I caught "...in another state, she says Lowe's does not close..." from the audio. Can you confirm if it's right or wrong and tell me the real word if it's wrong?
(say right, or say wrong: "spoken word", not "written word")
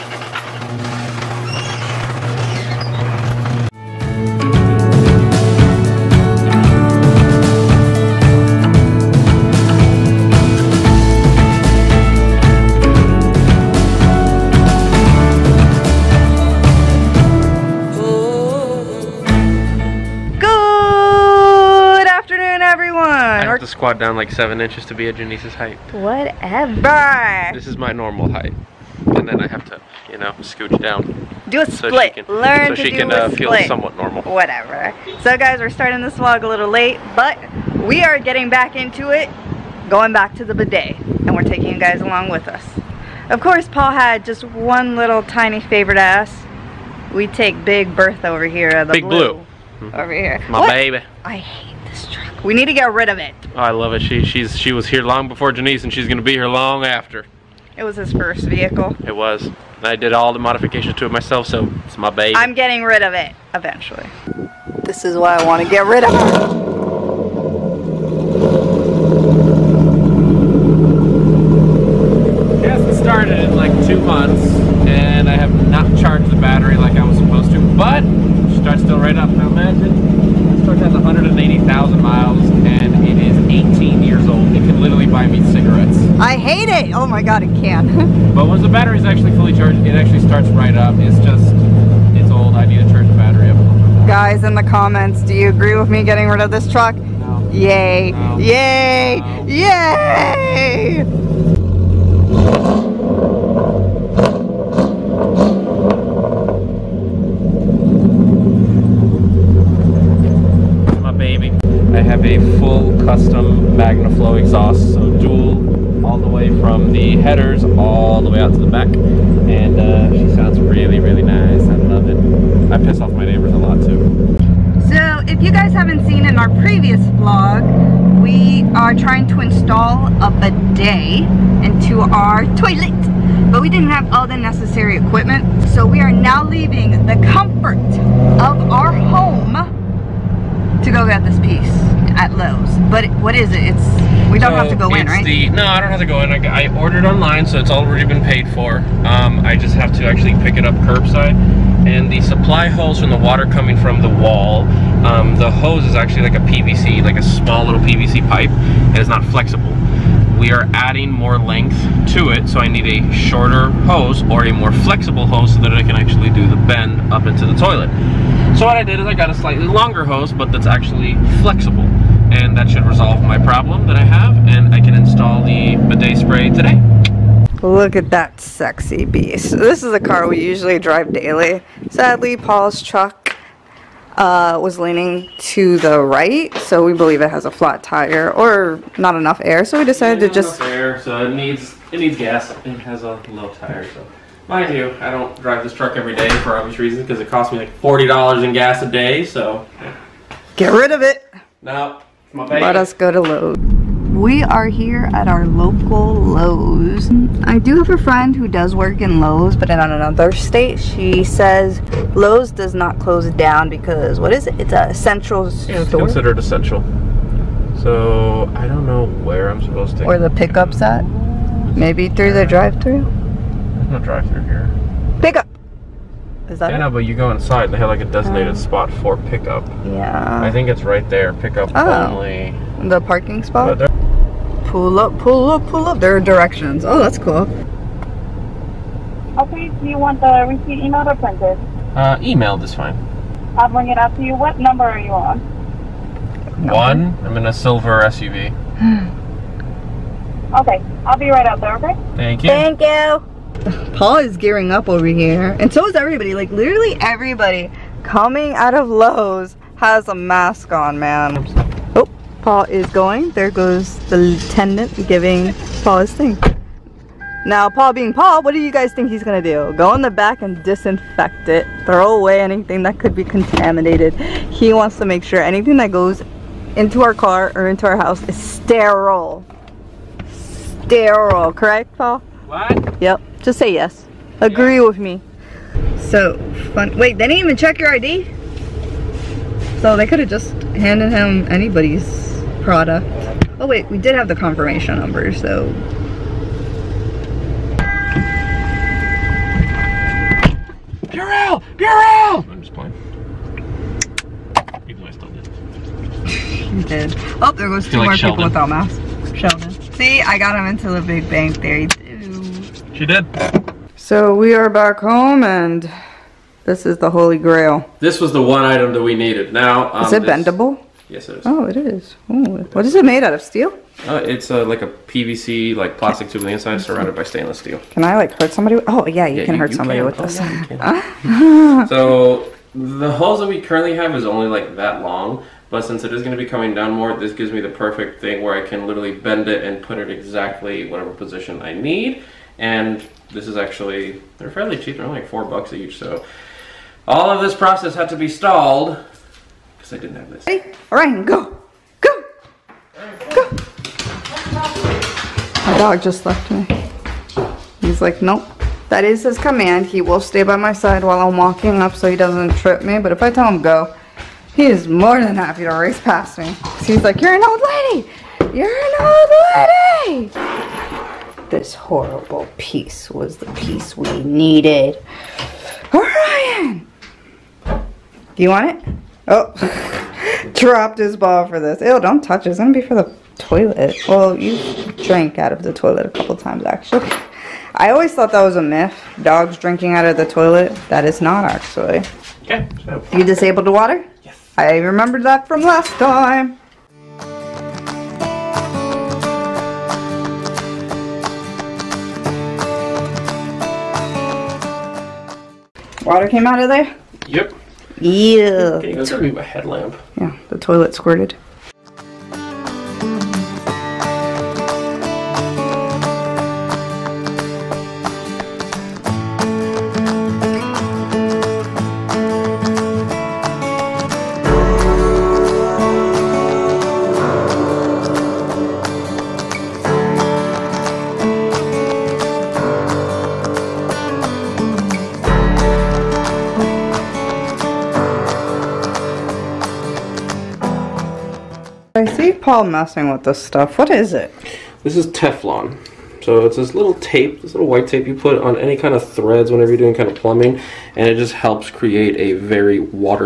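right.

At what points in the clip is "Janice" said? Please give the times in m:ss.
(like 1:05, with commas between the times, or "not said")
0:25, 0:55.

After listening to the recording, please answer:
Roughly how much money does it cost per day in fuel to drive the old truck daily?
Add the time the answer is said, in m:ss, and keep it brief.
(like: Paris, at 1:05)
$40, at 3:17.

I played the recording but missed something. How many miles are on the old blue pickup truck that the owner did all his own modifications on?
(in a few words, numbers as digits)
180,000.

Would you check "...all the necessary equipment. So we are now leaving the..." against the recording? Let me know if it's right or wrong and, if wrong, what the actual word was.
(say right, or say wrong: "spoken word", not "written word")
right.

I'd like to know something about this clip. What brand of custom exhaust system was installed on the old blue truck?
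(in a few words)
MagnaFlow.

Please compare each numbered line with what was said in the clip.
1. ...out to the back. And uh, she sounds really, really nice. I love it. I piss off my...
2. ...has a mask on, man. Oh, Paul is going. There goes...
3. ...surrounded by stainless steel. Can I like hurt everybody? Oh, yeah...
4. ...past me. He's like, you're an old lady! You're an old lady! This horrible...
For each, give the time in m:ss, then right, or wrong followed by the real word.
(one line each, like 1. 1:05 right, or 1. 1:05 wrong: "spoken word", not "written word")
1. 1:58 right
2. 4:19 right
3. 5:26 wrong: "somebody", not "everybody"
4. 6:05 right.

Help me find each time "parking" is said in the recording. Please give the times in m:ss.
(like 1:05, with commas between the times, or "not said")
3:52.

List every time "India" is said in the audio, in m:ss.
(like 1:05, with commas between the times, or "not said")
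not said.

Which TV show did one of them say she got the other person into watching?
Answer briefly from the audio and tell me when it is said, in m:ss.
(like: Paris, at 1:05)
The Big Bang Theory, at 5:11.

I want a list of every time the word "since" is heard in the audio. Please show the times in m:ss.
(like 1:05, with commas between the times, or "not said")
5:35.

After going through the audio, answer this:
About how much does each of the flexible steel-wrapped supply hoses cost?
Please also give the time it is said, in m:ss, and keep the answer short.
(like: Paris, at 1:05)
4 bucks, at 5:45.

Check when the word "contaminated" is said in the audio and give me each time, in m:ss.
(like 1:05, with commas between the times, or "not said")
4:33.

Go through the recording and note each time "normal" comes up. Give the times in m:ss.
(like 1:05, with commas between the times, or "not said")
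0:27, 0:33.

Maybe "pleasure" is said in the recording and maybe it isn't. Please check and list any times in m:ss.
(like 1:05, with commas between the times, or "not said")
not said.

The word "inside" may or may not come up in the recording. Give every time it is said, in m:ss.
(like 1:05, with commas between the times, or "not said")
3:47, 5:26.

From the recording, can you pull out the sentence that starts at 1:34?
Guys, in the comments, do you agree with me getting rid of this truck?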